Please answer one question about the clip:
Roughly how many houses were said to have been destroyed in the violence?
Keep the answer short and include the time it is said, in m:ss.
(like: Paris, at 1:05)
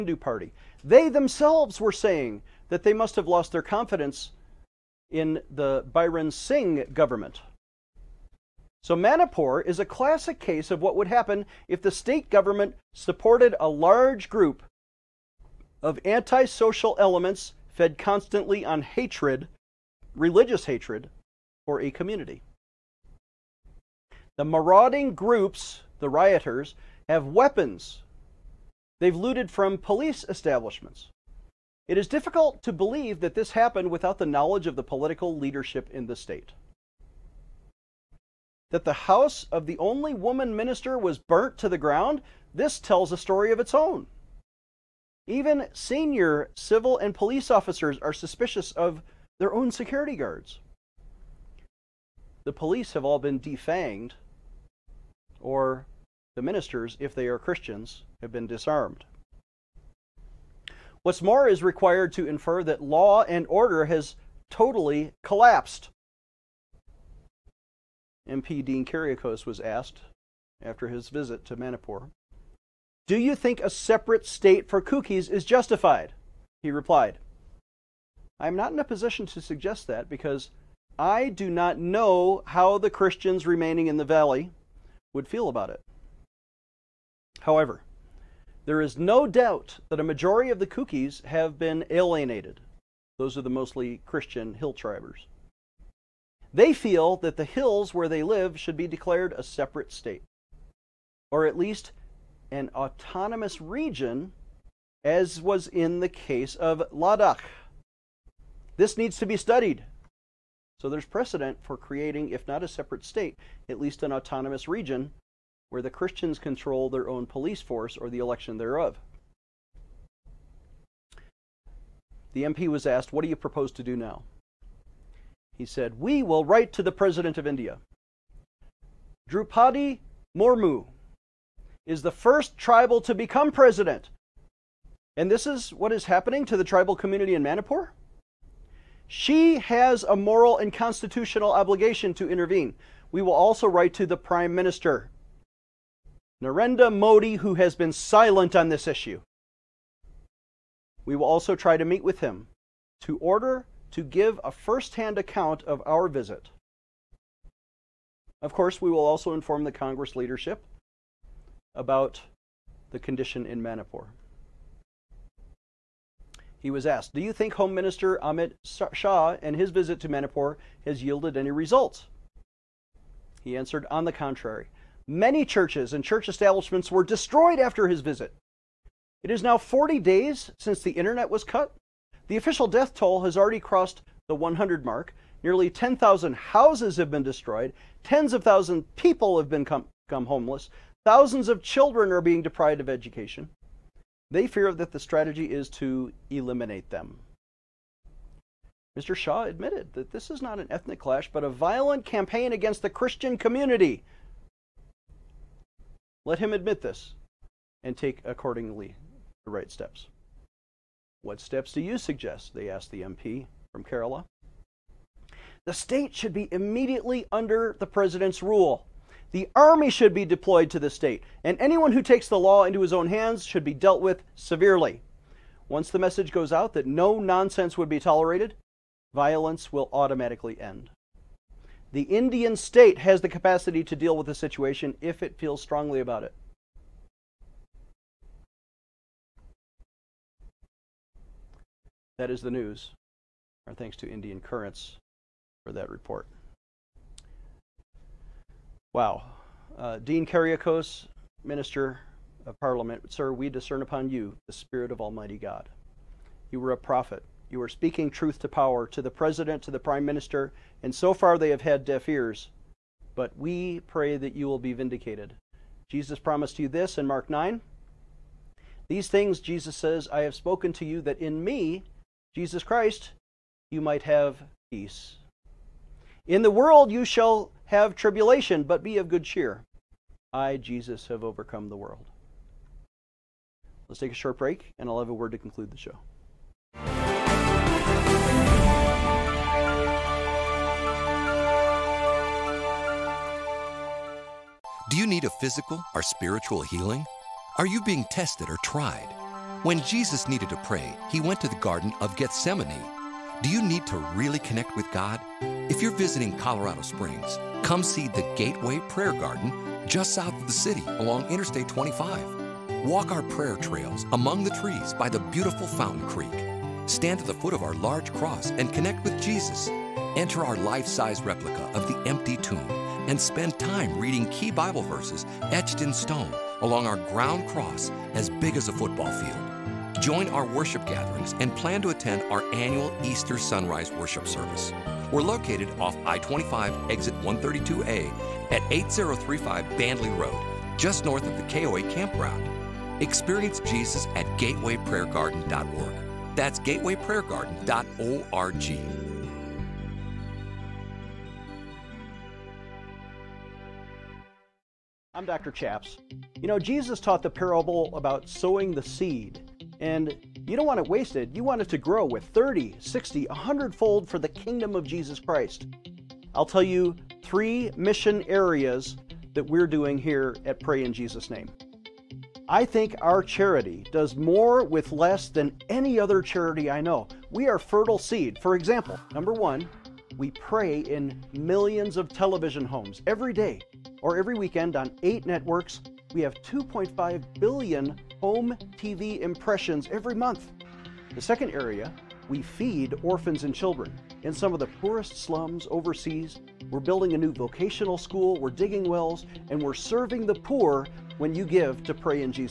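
10,000, at 3:05.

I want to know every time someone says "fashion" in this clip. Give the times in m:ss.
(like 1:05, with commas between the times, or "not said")
not said.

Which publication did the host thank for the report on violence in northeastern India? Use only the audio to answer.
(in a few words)
Indian Currents.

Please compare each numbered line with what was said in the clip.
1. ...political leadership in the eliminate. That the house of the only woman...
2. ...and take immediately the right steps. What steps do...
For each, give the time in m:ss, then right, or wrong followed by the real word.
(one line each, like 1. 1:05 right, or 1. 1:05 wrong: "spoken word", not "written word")
1. 0:34 wrong: "state", not "eliminate"
2. 3:27 wrong: "accordingly", not "immediately".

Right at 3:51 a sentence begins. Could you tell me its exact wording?
The Indian state has the capacity to deal with the situation if it feels strongly about it.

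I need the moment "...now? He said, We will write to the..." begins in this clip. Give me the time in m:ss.
2:03.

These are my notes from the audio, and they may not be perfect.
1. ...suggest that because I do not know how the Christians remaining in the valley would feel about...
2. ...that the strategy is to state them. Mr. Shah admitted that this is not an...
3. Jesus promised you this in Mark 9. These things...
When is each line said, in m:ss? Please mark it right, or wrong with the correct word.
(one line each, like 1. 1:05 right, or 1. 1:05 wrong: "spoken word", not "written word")
1. 1:19 right
2. 3:14 wrong: "eliminate", not "state"
3. 4:25 right.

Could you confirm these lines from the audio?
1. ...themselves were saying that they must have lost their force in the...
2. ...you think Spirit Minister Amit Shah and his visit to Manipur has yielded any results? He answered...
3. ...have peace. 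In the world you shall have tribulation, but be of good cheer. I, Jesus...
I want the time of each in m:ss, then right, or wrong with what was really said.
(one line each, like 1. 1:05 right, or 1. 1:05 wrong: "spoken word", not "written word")
1. 0:01 wrong: "confidence", not "force"
2. 2:47 wrong: "Home", not "Spirit"
3. 4:34 right.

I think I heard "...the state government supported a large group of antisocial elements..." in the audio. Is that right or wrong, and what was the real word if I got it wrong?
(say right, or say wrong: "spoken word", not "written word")
right.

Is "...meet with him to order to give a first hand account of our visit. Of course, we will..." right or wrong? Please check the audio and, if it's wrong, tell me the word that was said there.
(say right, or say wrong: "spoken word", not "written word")
right.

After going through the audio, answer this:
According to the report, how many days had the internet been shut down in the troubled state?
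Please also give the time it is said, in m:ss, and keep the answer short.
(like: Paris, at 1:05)
40, at 2:59.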